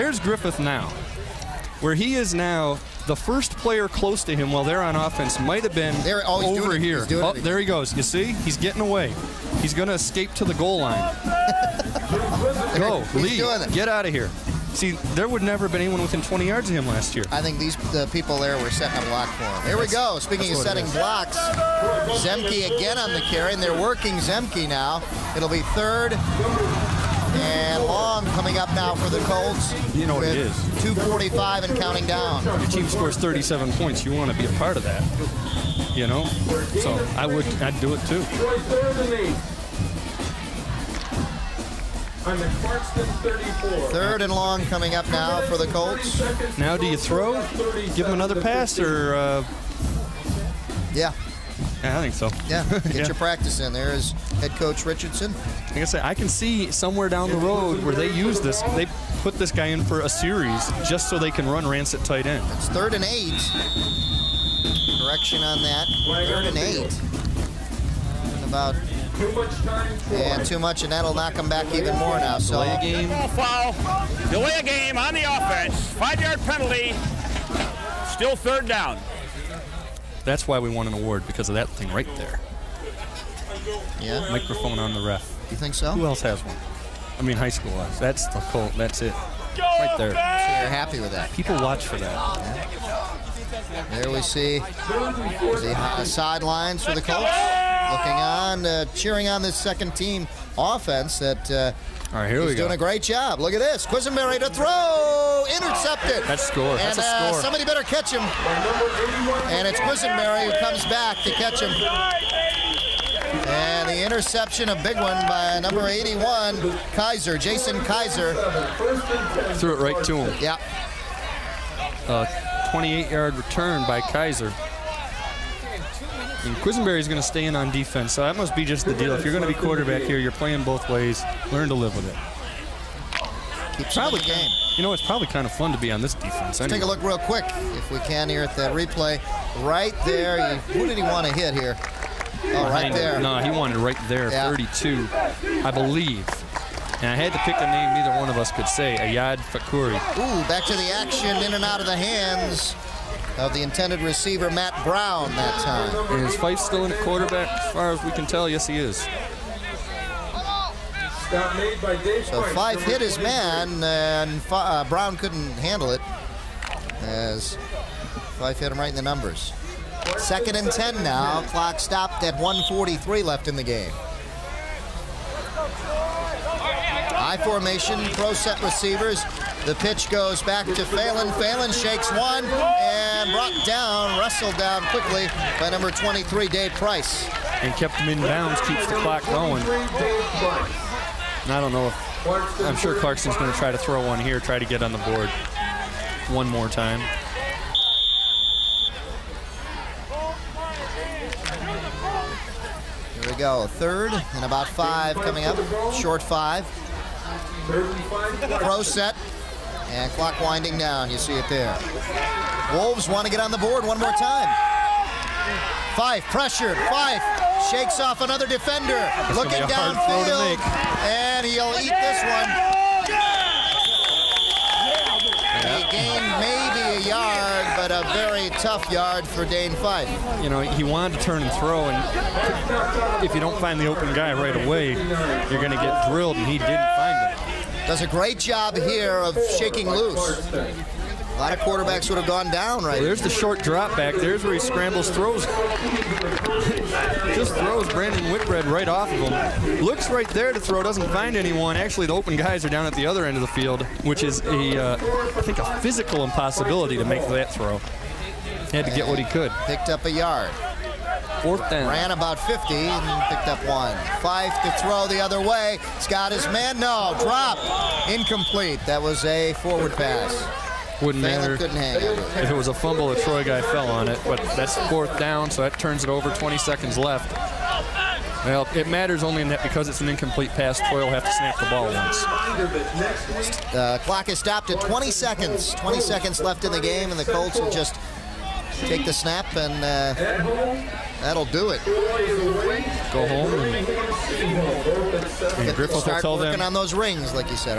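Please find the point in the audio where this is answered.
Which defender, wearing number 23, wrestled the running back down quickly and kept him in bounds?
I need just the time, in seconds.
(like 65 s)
186 s.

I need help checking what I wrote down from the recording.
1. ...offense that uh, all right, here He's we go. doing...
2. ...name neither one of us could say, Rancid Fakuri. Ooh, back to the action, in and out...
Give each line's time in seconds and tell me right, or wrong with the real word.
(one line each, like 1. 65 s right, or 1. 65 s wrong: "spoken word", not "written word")
1. 100 s right
2. 147 s wrong: "Ayad", not "Rancid".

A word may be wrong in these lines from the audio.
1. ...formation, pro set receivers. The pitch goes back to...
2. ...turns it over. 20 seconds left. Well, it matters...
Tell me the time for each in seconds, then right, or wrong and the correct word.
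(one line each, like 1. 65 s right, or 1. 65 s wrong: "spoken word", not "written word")
1. 177 s right
2. 275 s right.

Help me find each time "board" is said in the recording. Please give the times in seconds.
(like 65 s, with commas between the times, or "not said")
194 s, 213 s.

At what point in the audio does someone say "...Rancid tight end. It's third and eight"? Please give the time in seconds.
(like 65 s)
61 s.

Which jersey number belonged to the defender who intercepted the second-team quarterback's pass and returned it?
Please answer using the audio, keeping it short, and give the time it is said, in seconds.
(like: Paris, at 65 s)
81, at 115 s.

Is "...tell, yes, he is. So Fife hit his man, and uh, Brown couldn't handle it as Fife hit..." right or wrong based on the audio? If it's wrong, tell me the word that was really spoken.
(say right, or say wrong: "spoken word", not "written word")
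right.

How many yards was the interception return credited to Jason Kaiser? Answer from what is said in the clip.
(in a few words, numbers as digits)
28.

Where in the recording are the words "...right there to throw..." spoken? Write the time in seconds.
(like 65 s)
250 s.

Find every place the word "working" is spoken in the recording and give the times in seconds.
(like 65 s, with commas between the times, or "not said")
23 s, 296 s.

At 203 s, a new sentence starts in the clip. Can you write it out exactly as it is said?
Here we go, a third and about five coming up, short five.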